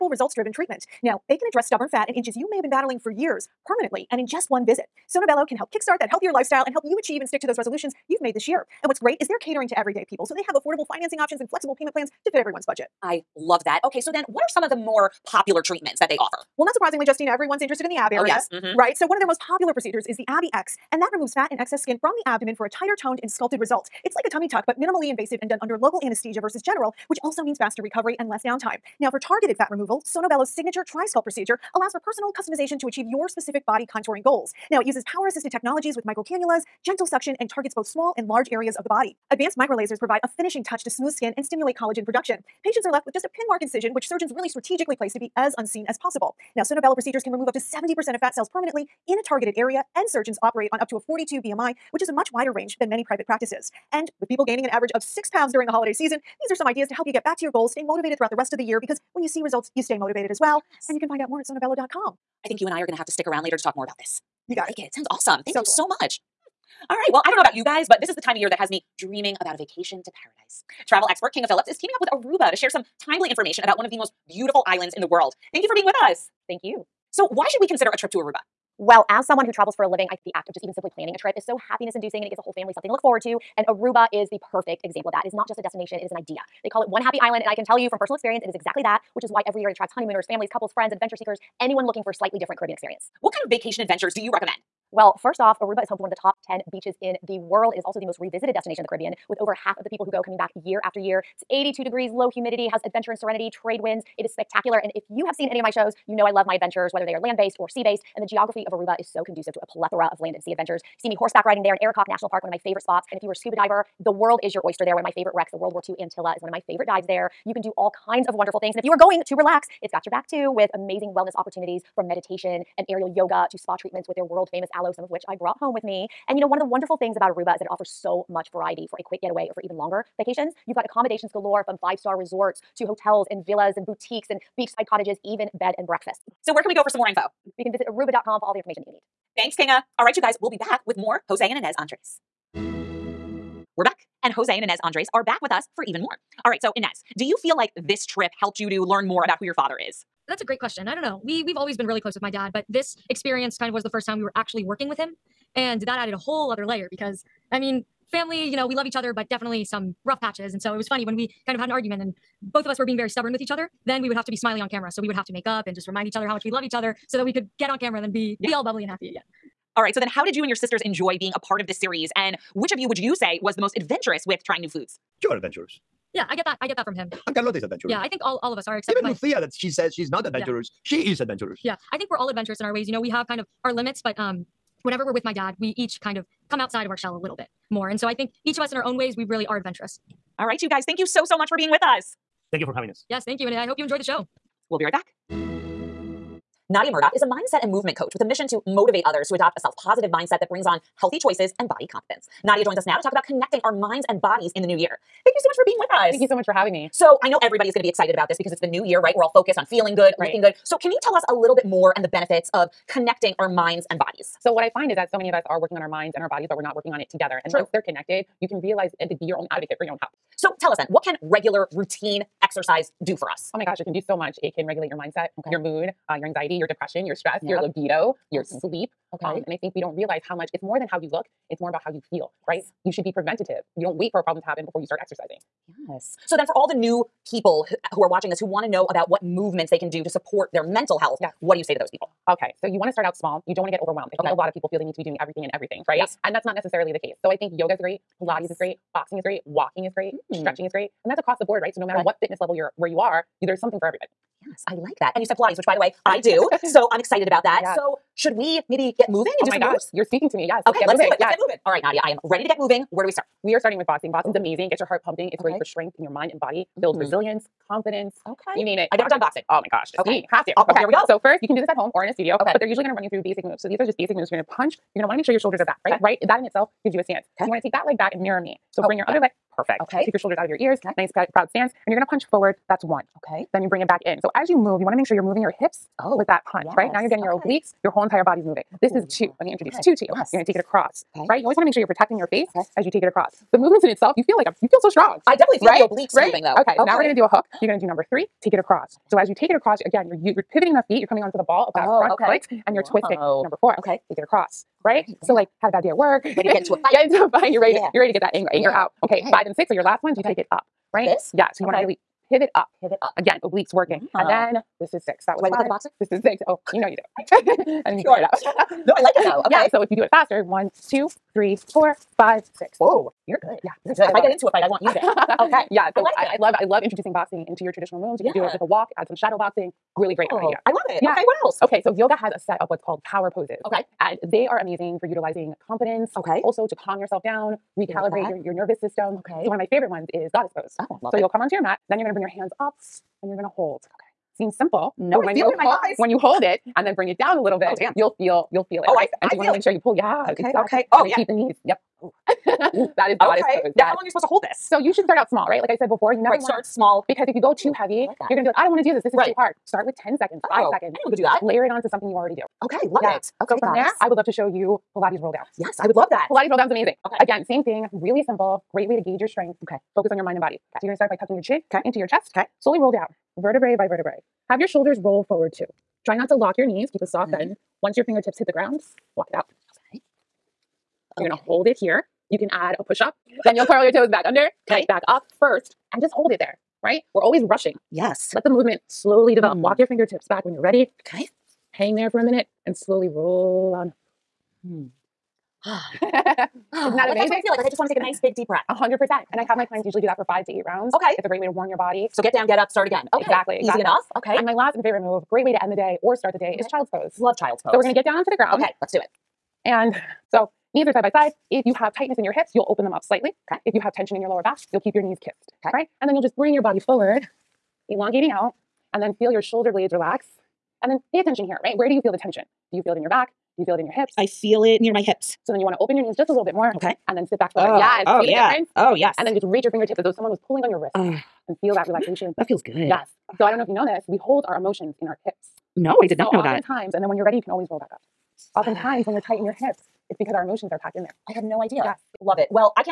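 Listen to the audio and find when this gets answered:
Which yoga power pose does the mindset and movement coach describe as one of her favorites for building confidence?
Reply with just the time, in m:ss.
5:40.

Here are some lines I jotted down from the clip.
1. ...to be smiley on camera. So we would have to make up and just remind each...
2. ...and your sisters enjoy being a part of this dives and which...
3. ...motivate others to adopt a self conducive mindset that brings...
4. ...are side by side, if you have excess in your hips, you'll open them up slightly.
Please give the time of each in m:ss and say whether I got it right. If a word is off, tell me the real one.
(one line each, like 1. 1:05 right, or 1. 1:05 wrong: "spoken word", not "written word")
1. 2:44 right
2. 2:50 wrong: "series", not "dives"
3. 3:18 wrong: "positive", not "conducive"
4. 6:50 wrong: "tightness", not "excess".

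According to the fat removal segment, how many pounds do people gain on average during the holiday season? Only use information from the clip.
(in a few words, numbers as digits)
6.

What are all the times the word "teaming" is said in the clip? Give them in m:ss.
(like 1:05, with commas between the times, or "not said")
1:11.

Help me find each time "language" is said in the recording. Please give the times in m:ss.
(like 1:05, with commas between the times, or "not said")
not said.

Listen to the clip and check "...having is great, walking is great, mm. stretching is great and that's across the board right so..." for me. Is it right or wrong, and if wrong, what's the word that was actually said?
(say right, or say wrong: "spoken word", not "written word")
wrong: "boxing", not "having".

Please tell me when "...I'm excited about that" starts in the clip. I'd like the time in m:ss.
4:16.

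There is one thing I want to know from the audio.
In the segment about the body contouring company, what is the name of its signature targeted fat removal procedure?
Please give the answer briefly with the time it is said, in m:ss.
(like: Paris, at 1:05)
TriSculpt, at 0:30.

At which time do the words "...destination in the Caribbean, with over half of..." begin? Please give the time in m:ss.
1:38.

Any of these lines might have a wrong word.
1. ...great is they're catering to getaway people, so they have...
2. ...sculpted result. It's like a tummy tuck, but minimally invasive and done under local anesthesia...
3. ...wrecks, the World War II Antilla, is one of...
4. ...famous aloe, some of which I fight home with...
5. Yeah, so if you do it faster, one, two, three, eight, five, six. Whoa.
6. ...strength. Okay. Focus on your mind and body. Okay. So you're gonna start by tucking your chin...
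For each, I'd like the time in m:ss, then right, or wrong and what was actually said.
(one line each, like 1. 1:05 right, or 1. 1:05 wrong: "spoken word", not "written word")
1. 0:08 wrong: "everyday", not "getaway"
2. 0:23 right
3. 1:55 right
4. 2:04 wrong: "brought", not "fight"
5. 5:19 wrong: "four", not "eight"
6. 6:09 right.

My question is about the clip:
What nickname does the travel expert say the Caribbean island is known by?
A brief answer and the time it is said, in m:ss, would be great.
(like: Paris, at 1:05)
One Happy Island, at 1:26.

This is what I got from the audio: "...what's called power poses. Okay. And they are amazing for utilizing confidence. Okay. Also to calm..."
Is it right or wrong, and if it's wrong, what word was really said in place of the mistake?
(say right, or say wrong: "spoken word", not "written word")
right.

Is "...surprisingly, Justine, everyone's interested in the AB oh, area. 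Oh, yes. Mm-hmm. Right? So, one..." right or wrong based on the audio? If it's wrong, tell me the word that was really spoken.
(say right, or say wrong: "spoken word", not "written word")
right.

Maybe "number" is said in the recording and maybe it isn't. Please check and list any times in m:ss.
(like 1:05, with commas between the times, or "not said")
4:57, 5:03.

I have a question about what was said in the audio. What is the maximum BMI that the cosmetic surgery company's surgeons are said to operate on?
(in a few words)
42.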